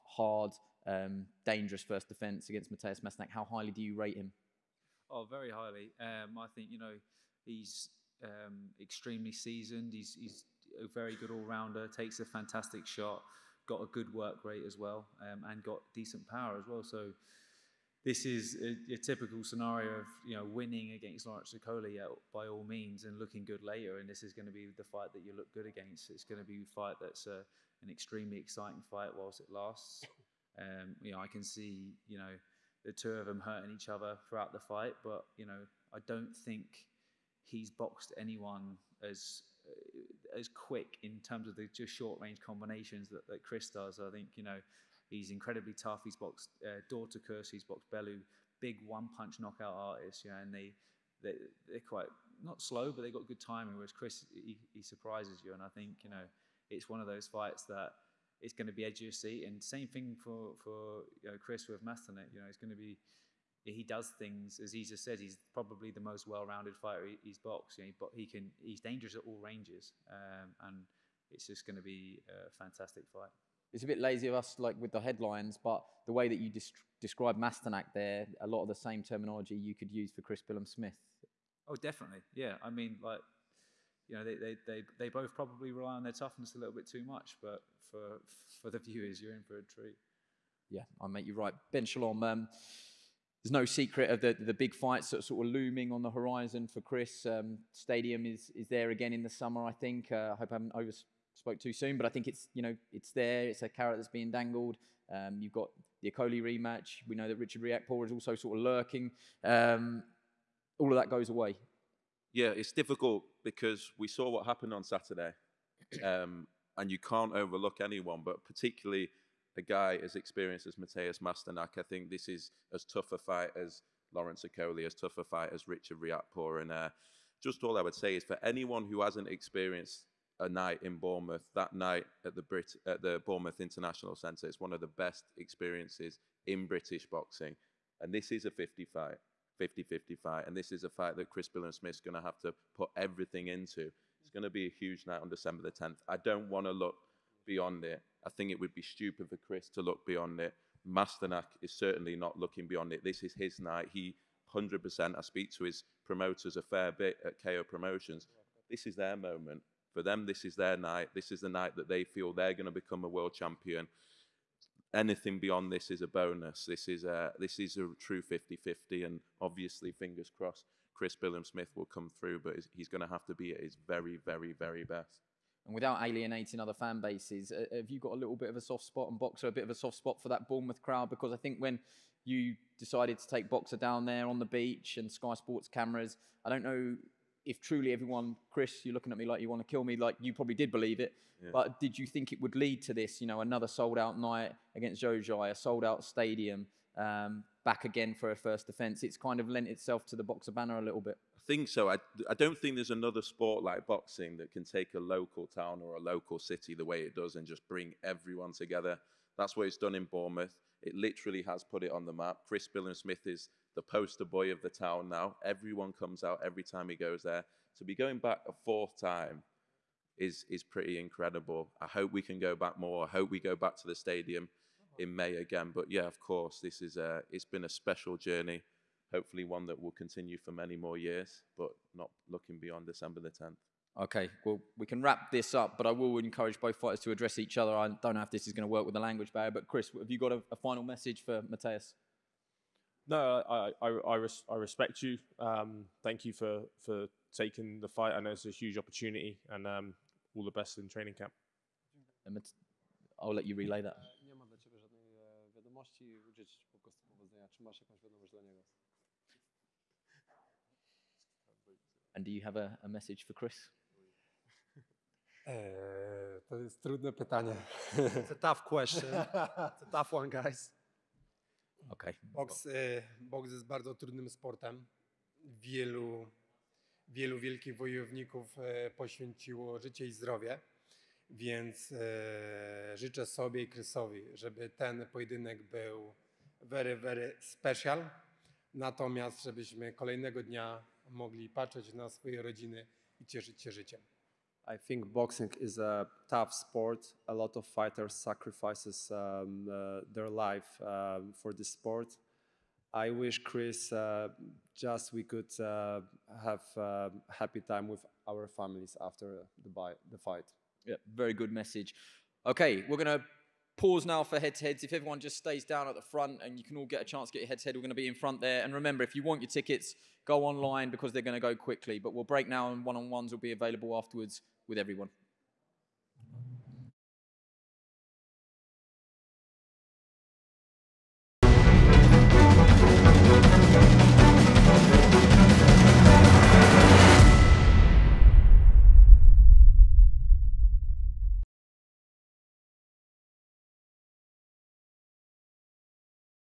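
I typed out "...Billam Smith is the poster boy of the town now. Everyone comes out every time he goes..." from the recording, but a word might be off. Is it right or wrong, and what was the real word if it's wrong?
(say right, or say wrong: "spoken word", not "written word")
right.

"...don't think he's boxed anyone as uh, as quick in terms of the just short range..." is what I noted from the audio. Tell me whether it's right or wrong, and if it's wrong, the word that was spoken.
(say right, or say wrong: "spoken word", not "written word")
right.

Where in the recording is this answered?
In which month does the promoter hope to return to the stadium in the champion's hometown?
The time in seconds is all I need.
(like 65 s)
225 s.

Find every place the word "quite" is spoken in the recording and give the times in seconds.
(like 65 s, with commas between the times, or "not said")
51 s.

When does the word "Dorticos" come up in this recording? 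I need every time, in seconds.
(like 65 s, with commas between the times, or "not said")
46 s.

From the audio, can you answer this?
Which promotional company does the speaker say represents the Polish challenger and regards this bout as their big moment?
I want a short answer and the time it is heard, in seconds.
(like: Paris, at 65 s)
KO Promotions, at 157 s.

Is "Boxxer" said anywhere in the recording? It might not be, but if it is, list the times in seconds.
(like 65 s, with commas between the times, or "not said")
179 s, 183 s, 200 s.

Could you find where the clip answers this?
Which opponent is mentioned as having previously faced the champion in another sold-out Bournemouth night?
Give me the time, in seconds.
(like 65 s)
195 s.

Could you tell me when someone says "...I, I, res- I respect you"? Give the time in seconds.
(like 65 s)
243 s.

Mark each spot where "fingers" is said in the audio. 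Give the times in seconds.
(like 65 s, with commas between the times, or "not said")
169 s.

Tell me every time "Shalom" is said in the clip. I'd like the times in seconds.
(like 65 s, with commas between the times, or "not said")
91 s.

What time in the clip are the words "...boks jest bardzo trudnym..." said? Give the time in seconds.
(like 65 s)
273 s.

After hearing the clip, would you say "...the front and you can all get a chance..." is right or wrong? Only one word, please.
right.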